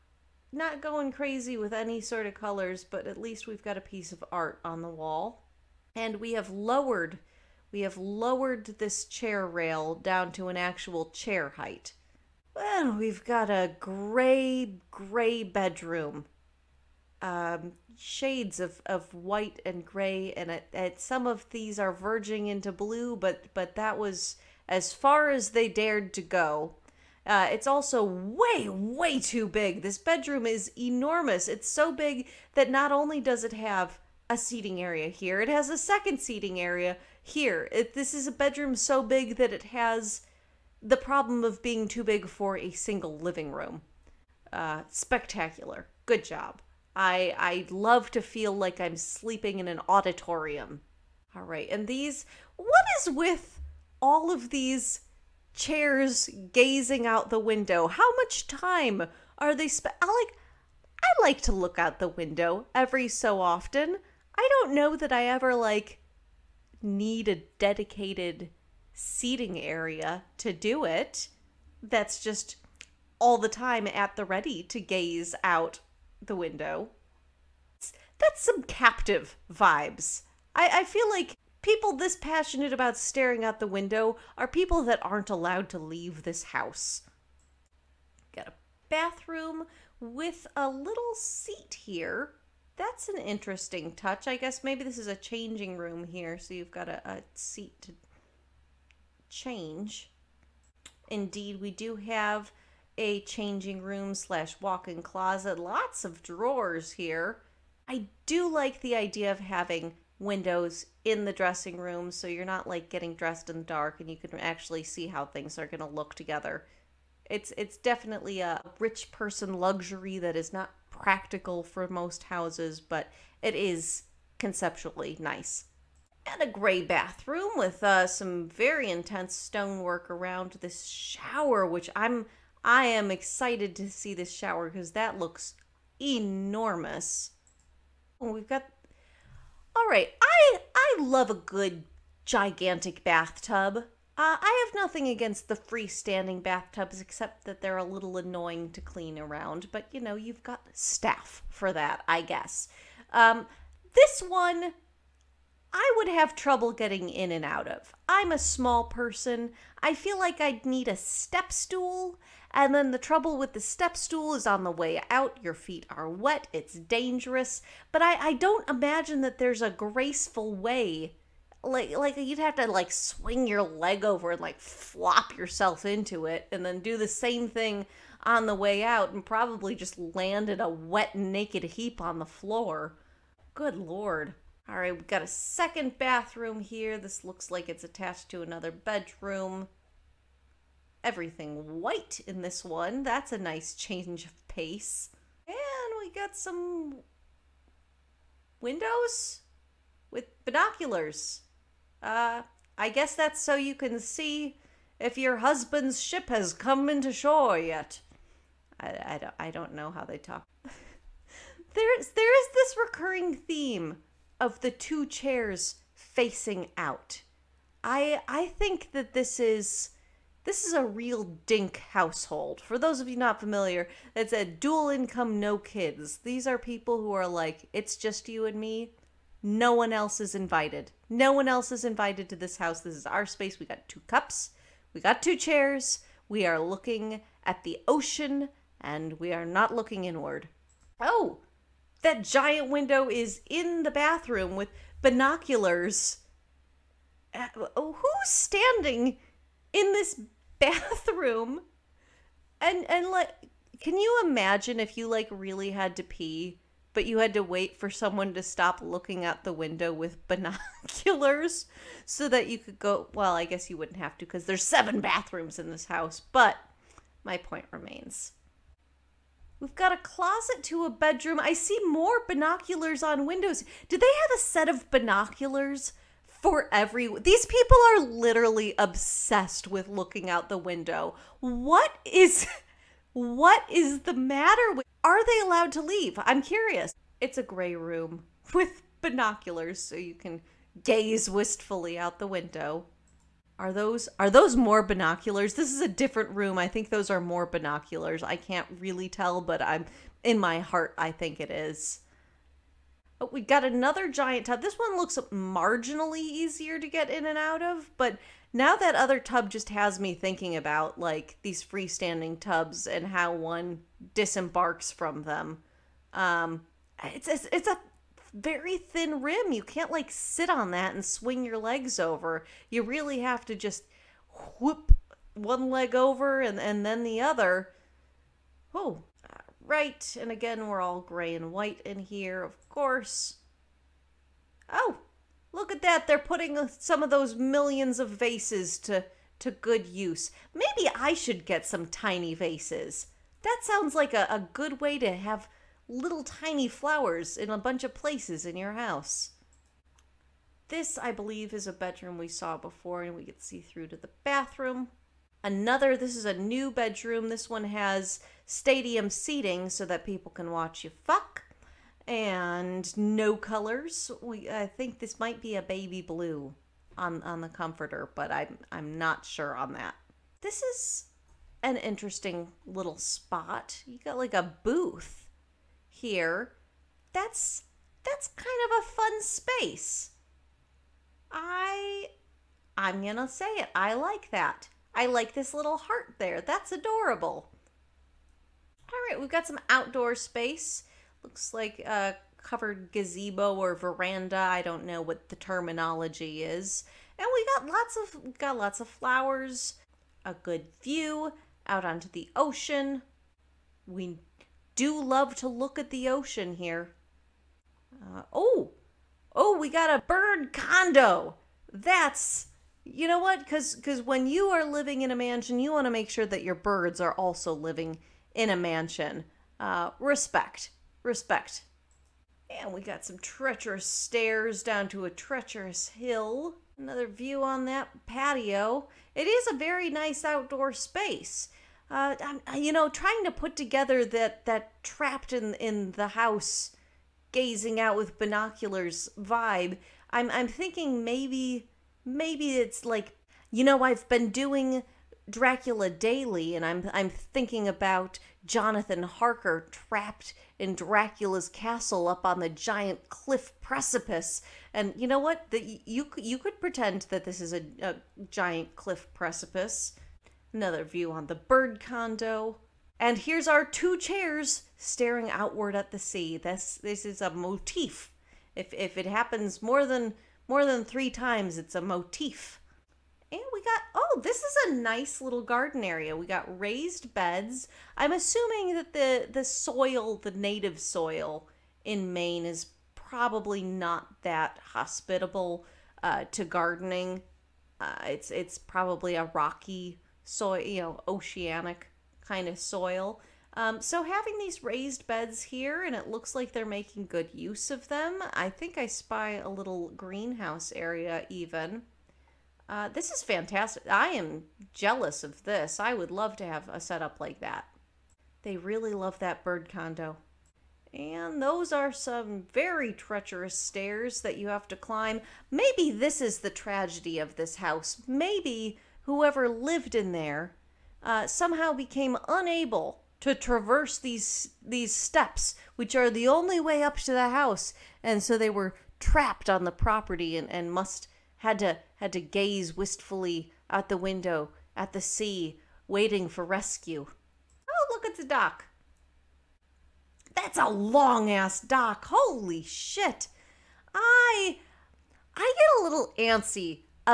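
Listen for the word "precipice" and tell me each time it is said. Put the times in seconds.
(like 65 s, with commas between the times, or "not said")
453 s, 459 s.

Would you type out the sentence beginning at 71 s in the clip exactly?
That's just all the time at the ready to gaze out the window.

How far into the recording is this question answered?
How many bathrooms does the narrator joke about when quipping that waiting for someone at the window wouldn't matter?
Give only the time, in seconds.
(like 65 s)
264 s.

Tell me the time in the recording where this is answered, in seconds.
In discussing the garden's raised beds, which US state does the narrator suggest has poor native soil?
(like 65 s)
482 s.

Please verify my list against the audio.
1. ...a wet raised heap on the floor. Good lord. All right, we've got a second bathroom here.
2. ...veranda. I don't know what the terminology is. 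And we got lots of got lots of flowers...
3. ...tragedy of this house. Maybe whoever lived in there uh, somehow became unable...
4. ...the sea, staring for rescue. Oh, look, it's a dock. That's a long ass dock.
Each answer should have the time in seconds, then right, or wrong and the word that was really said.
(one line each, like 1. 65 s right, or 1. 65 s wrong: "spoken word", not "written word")
1. 180 s wrong: "naked", not "raised"
2. 393 s right
3. 516 s right
4. 534 s wrong: "waiting", not "staring".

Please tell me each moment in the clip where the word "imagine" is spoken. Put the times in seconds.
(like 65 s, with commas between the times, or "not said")
168 s, 254 s.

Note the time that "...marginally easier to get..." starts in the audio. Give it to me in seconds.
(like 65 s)
305 s.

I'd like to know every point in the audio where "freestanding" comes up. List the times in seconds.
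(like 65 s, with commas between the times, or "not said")
145 s, 311 s.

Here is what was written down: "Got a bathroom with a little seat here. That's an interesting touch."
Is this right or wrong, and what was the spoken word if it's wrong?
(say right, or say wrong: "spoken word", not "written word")
right.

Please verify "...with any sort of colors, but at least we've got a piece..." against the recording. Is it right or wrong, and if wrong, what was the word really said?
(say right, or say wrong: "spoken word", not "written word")
right.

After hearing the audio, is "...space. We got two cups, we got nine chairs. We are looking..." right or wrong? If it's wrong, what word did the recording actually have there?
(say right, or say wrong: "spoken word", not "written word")
wrong: "two", not "nine".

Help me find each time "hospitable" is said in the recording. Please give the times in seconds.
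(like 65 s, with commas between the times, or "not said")
484 s.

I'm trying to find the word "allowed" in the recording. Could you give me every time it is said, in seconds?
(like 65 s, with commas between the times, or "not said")
85 s, 285 s.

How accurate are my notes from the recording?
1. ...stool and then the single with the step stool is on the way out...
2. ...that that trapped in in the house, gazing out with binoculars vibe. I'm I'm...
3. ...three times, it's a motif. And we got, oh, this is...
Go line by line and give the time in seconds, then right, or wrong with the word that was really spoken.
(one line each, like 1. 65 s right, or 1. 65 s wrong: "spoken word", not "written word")
1. 161 s wrong: "trouble", not "single"
2. 434 s right
3. 470 s right.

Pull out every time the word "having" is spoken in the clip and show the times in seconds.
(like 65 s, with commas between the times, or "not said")
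109 s, 494 s.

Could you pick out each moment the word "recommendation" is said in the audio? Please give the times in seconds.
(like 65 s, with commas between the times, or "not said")
not said.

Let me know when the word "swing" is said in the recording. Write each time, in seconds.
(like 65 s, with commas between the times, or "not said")
172 s, 321 s.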